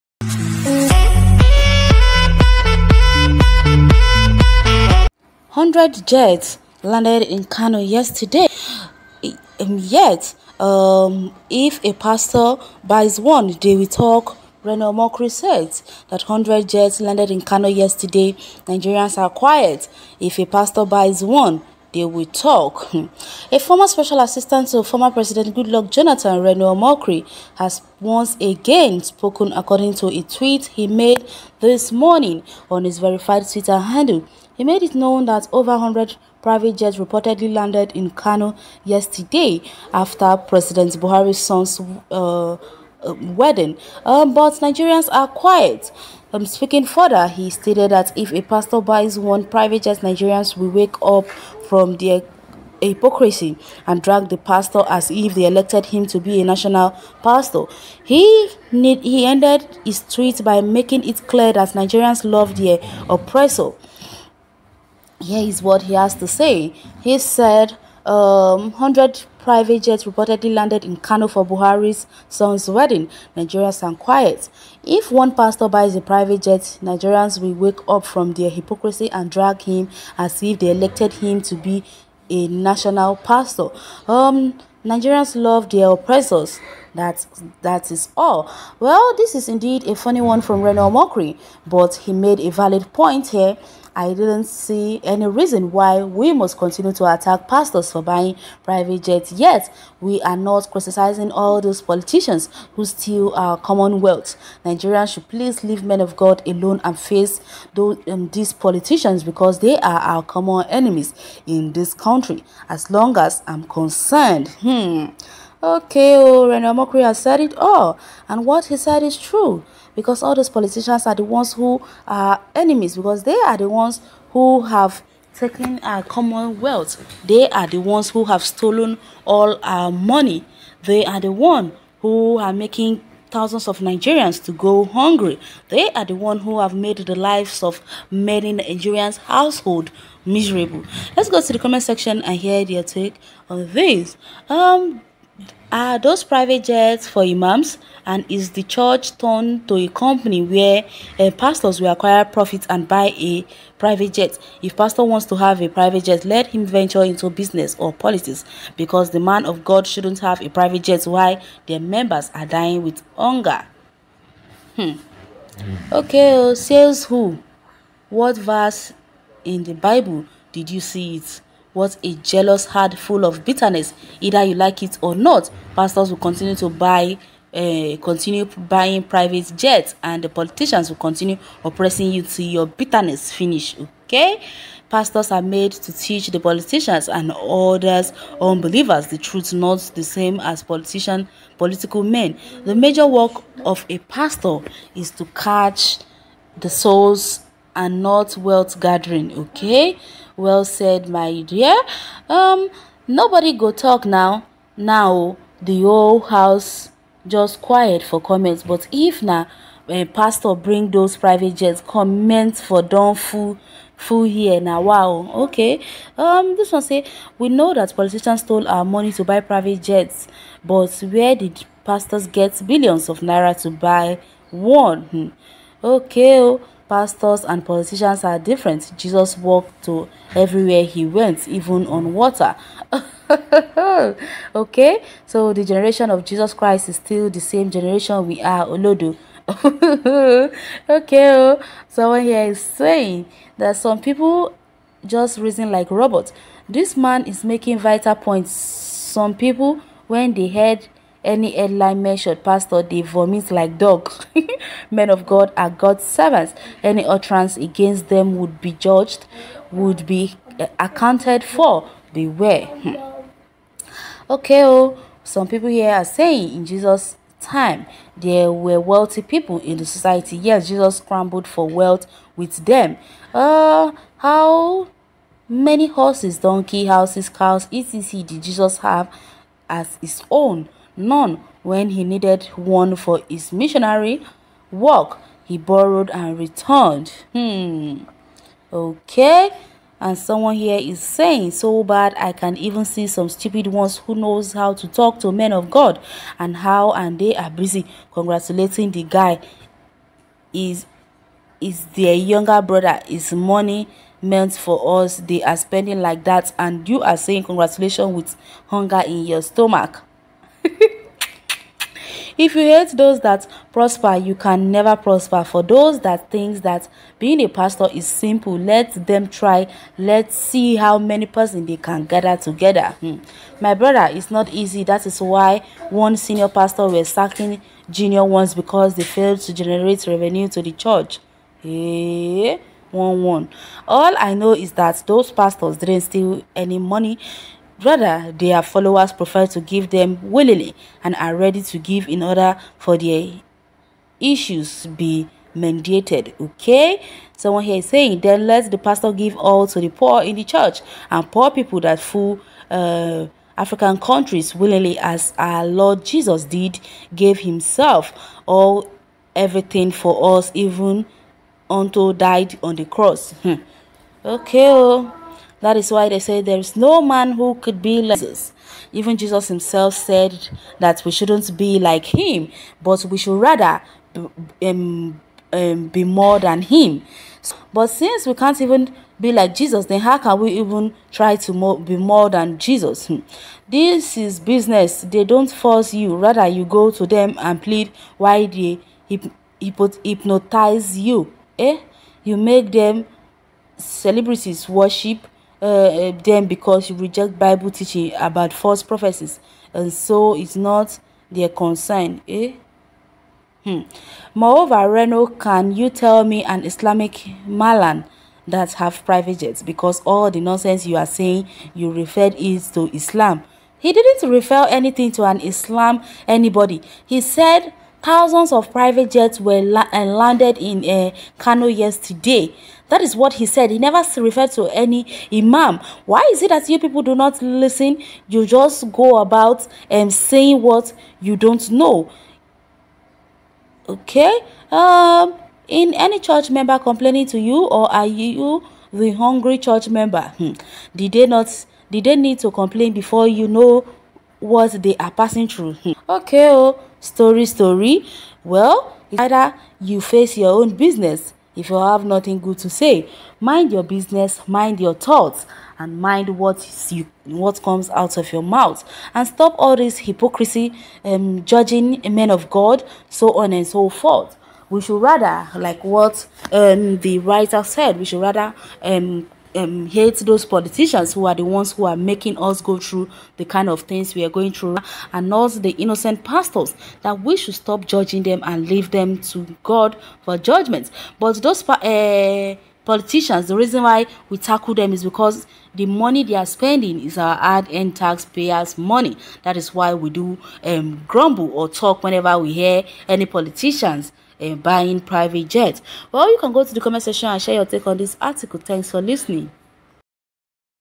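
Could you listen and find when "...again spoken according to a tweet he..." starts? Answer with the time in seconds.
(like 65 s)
28 s.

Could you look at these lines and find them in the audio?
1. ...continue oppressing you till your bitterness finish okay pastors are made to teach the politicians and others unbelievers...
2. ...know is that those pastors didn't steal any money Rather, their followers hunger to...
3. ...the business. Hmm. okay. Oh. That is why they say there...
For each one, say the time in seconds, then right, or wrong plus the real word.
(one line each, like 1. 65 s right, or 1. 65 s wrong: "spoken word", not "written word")
1. 180 s right
2. 334 s wrong: "prefer", not "hunger"
3. 362 s wrong: "cross", not "business".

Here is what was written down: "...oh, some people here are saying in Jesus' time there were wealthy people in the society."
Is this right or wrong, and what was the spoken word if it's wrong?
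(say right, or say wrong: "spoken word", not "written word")
right.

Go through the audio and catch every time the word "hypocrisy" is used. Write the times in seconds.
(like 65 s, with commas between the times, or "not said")
52 s, 78 s, 459 s.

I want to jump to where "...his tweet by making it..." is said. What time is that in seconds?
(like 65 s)
59 s.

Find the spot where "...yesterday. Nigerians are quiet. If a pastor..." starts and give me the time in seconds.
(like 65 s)
17 s.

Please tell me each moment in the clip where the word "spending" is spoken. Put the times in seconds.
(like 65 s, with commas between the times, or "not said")
305 s, 486 s.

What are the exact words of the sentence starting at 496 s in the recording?
Well, you can go to the comment section and share your take on this article.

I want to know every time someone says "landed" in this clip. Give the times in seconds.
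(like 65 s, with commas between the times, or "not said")
6 s, 17 s, 37 s, 70 s, 420 s.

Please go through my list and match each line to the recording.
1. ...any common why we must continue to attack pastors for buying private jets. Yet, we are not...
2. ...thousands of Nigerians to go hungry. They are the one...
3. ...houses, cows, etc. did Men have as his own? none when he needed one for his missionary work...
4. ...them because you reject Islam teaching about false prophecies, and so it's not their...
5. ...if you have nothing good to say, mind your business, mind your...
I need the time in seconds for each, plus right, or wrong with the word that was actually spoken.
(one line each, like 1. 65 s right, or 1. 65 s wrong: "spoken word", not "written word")
1. 95 s wrong: "reason", not "common"
2. 133 s right
3. 276 s wrong: "Jesus", not "Men"
4. 396 s wrong: "Bible", not "Islam"
5. 451 s right.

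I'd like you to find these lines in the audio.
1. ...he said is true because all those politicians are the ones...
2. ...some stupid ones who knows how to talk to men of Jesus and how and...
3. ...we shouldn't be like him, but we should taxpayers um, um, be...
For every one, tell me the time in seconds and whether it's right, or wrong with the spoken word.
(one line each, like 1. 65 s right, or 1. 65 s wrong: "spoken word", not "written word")
1. 118 s right
2. 293 s wrong: "God", not "Jesus"
3. 371 s wrong: "rather", not "taxpayers".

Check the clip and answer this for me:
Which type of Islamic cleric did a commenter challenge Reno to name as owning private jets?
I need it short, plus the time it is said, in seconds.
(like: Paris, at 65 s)
Malan, at 407 s.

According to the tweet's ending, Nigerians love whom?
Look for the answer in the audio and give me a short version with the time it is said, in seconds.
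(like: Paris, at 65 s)
their oppressors, at 85 s.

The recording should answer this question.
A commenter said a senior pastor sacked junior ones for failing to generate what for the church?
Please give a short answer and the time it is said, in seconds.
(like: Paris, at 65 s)
revenue, at 330 s.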